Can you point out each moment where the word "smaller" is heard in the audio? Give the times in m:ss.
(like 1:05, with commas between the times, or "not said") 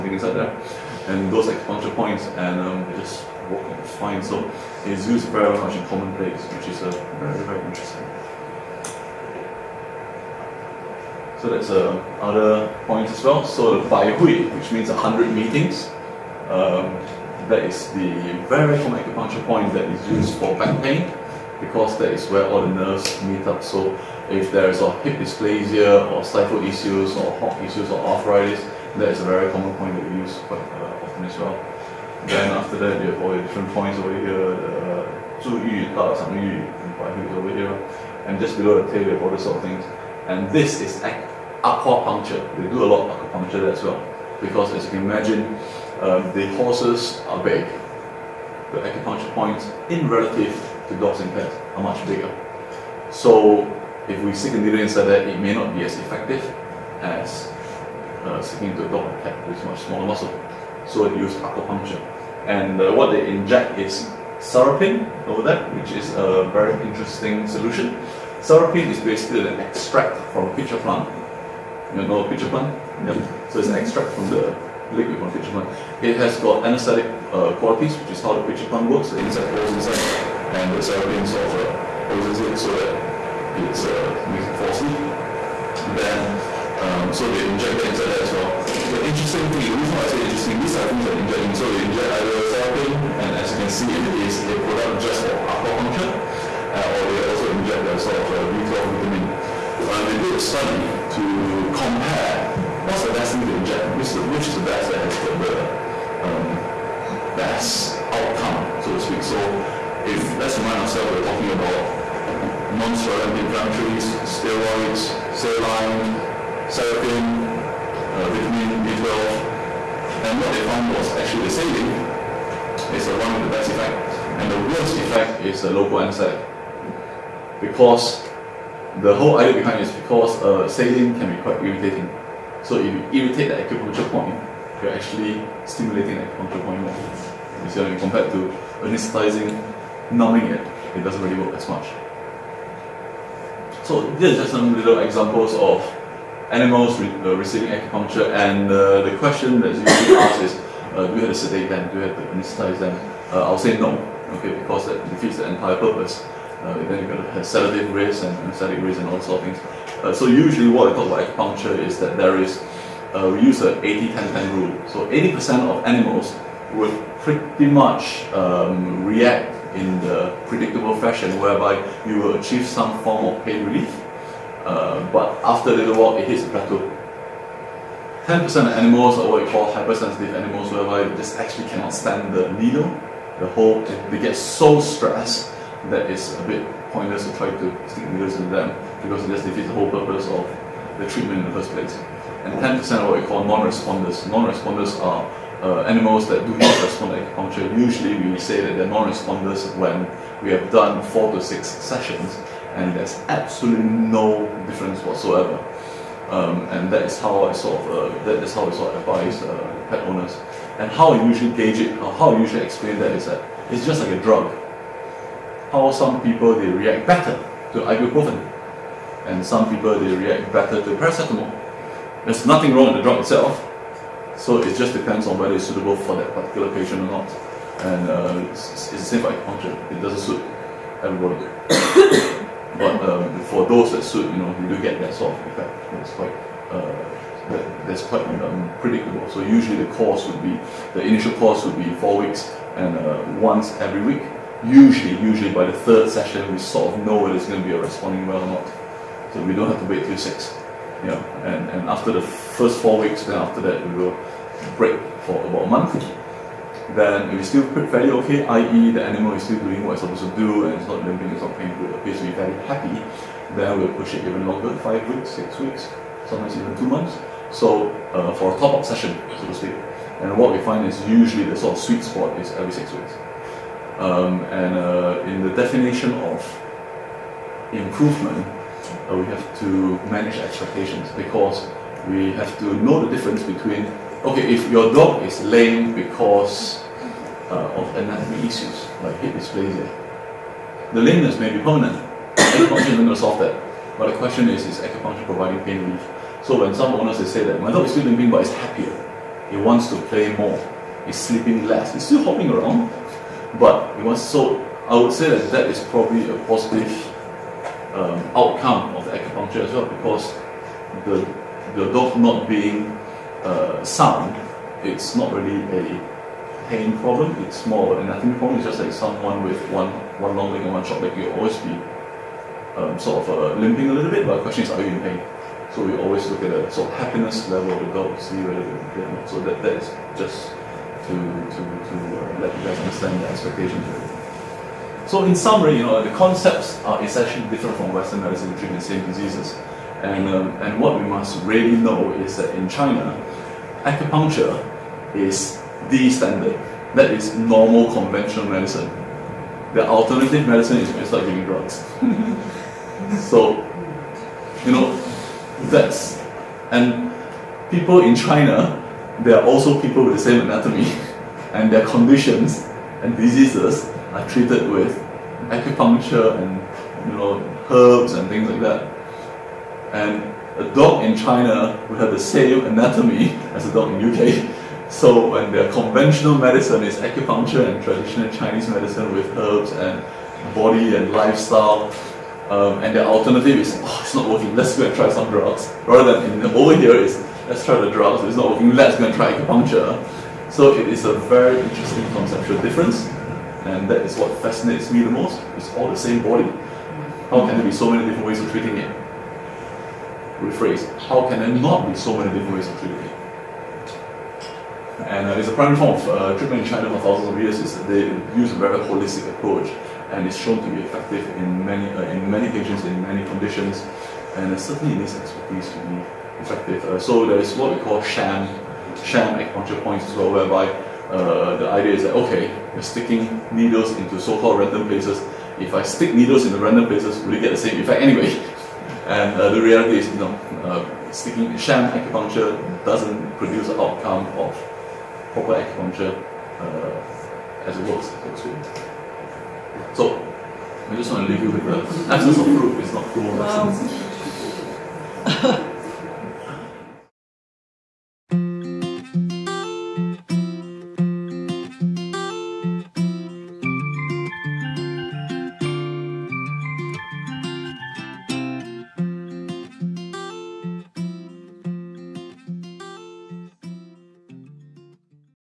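0:59.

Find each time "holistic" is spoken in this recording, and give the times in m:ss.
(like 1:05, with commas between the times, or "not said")
6:48.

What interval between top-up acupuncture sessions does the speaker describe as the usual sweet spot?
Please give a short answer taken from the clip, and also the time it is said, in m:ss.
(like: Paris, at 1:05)
every 6 weeks, at 4:32.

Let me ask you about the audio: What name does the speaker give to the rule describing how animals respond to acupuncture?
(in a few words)
80-10-10 rule.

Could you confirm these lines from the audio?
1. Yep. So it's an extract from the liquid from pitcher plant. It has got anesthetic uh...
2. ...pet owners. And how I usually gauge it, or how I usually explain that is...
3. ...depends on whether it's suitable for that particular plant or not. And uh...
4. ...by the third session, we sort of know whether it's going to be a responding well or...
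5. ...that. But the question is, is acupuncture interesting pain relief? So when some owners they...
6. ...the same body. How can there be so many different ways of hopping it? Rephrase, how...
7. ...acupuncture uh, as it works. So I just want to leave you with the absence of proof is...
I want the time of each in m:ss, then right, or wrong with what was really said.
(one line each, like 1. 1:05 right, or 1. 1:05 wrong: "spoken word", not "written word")
1. 1:13 right
2. 3:29 right
3. 3:44 wrong: "patient", not "plant"
4. 4:05 right
5. 4:53 wrong: "providing", not "interesting"
6. 6:35 wrong: "treating", not "hopping"
7. 7:15 right.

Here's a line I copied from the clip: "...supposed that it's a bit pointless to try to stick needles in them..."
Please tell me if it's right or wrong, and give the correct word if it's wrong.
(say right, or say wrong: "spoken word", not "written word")
wrong: "stressed", not "supposed".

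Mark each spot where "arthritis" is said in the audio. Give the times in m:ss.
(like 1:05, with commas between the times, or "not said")
0:27.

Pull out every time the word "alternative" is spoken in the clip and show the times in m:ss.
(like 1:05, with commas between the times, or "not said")
5:49, 6:23.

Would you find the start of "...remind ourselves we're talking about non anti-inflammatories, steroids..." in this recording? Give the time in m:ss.
1:50.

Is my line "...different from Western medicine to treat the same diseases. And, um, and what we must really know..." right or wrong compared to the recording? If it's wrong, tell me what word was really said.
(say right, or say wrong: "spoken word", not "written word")
right.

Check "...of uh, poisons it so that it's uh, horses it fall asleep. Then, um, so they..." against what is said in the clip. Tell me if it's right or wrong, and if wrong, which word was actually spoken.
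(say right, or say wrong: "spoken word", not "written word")
wrong: "makes", not "horses".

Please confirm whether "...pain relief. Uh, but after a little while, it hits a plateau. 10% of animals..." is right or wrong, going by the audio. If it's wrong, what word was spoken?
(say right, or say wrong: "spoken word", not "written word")
right.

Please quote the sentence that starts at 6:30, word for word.
So it is a very interesting conceptual difference.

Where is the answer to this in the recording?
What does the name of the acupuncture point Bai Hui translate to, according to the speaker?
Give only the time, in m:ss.
0:14.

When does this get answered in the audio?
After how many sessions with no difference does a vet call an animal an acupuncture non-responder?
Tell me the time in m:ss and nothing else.
3:21.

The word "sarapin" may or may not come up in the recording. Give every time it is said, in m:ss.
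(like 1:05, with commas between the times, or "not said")
1:04, 1:08, 1:20, 1:32, 1:56.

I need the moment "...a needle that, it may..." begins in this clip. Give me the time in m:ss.
0:54.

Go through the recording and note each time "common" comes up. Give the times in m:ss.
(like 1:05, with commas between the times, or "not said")
0:18, 0:29.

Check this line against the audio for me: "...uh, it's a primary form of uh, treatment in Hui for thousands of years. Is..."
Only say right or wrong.
wrong.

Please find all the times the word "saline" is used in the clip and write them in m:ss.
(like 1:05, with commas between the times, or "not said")
1:55, 2:01, 2:10.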